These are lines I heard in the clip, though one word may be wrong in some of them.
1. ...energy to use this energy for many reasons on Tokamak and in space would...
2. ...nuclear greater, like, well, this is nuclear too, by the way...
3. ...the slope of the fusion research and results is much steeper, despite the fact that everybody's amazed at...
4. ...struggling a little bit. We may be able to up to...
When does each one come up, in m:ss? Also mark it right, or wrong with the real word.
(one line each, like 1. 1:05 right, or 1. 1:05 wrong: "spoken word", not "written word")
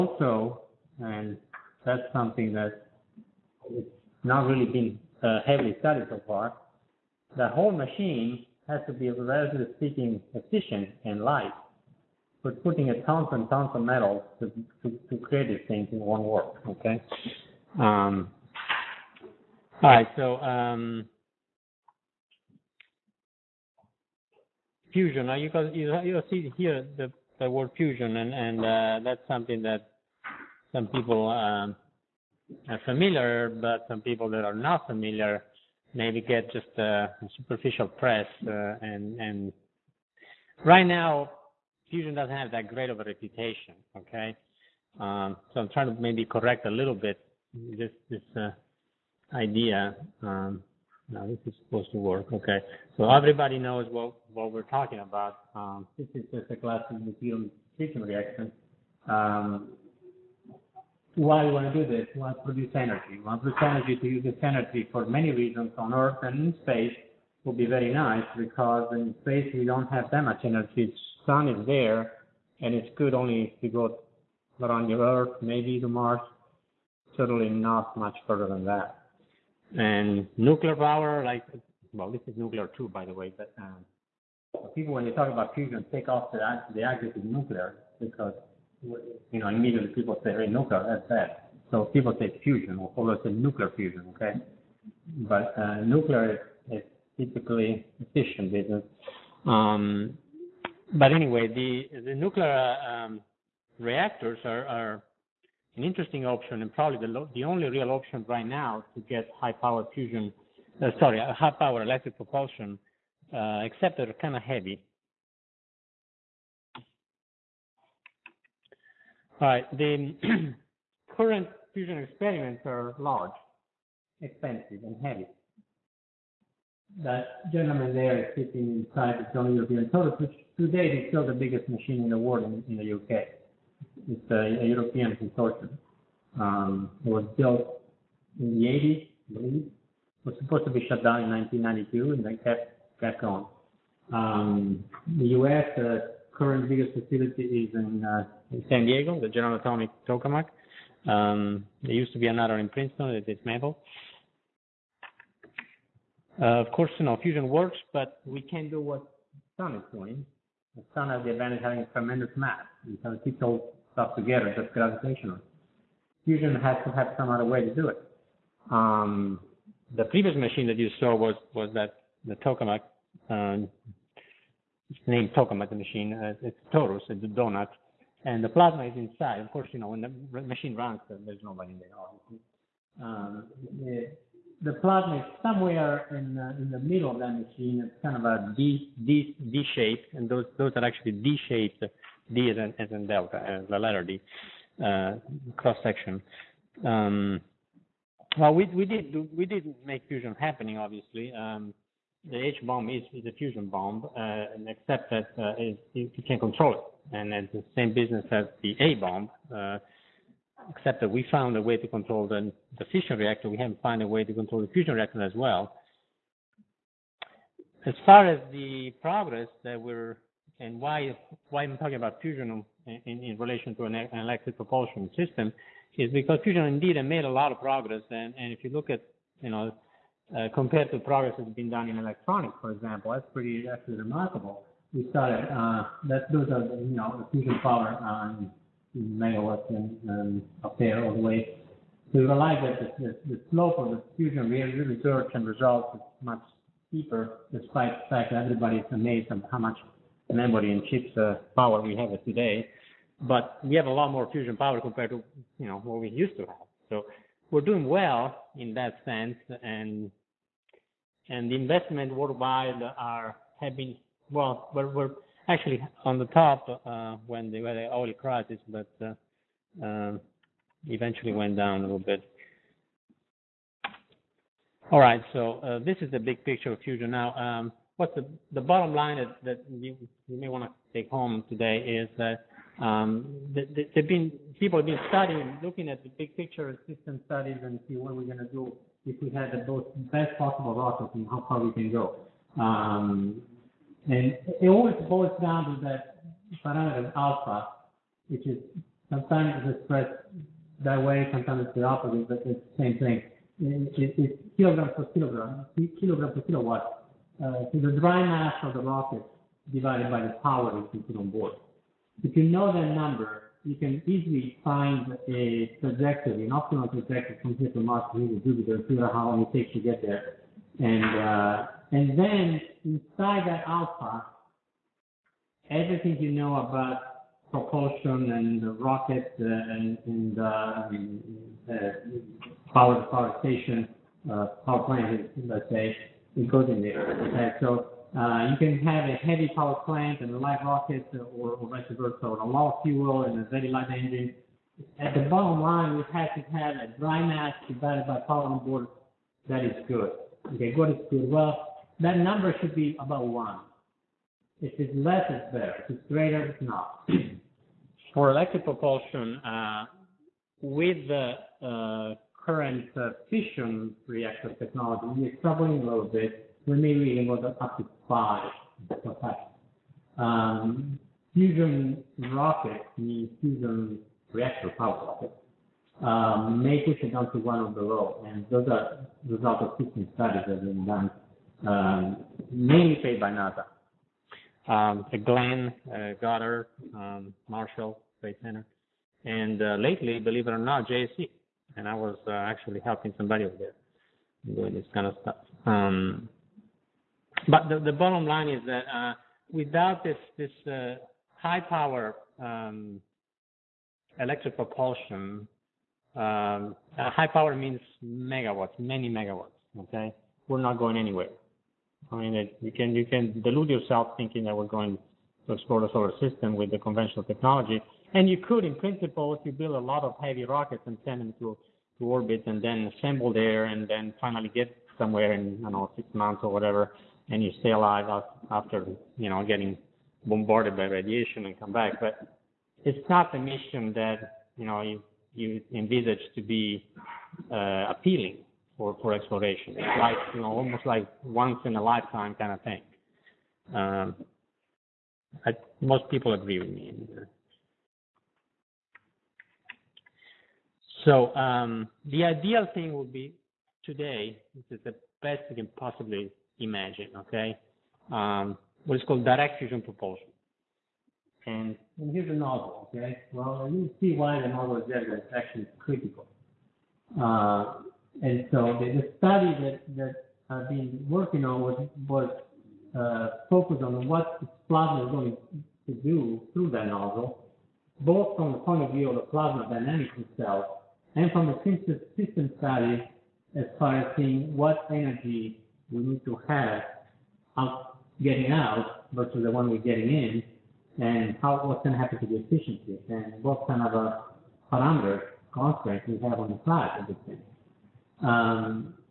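1. 1:03 wrong: "Earth", not "Tokamak"
2. 1:20 wrong: "power", not "greater"
3. 4:03 right
4. 6:05 right.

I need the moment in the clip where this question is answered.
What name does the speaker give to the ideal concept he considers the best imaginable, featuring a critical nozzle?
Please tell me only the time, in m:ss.
7:39.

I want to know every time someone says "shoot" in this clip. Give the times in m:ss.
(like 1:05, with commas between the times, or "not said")
not said.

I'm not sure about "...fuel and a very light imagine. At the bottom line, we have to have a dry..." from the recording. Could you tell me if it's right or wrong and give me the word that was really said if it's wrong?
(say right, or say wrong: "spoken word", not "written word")
wrong: "engine", not "imagine".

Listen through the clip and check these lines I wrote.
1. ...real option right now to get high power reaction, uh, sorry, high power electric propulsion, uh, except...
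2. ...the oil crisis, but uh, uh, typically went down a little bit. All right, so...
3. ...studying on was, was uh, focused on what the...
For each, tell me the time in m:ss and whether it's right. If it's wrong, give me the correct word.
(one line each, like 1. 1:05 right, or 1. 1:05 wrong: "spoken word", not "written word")
1. 1:47 wrong: "fusion", not "reaction"
2. 4:27 wrong: "eventually", not "typically"
3. 7:51 wrong: "working", not "studying".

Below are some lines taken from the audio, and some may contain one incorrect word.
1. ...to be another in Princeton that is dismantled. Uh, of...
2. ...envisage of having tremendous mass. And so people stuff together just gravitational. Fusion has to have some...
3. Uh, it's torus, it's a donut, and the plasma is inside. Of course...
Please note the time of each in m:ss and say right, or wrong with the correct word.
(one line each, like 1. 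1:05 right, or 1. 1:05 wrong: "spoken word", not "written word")
1. 2:32 right
2. 2:41 wrong: "advantage", not "envisage"
3. 2:56 right.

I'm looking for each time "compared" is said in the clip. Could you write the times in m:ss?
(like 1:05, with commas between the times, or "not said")
3:50, 4:14.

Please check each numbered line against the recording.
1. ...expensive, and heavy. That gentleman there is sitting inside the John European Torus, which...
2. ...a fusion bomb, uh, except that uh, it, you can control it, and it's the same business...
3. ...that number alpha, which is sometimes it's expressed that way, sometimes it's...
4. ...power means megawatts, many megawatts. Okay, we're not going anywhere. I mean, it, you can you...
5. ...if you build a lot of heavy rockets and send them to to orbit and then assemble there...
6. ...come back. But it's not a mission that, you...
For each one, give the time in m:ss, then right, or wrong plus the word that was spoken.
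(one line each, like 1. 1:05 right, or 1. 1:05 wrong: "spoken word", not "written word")
1. 2:04 right
2. 3:23 right
3. 4:55 wrong: "parameter", not "number"
4. 6:47 right
5. 6:59 right
6. 7:11 right.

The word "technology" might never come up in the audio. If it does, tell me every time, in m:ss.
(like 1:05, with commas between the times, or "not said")
6:04, 6:57.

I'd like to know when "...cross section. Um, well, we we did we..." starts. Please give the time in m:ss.
3:15.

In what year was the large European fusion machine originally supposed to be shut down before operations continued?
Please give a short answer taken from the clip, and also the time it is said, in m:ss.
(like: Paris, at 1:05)
1992, at 2:21.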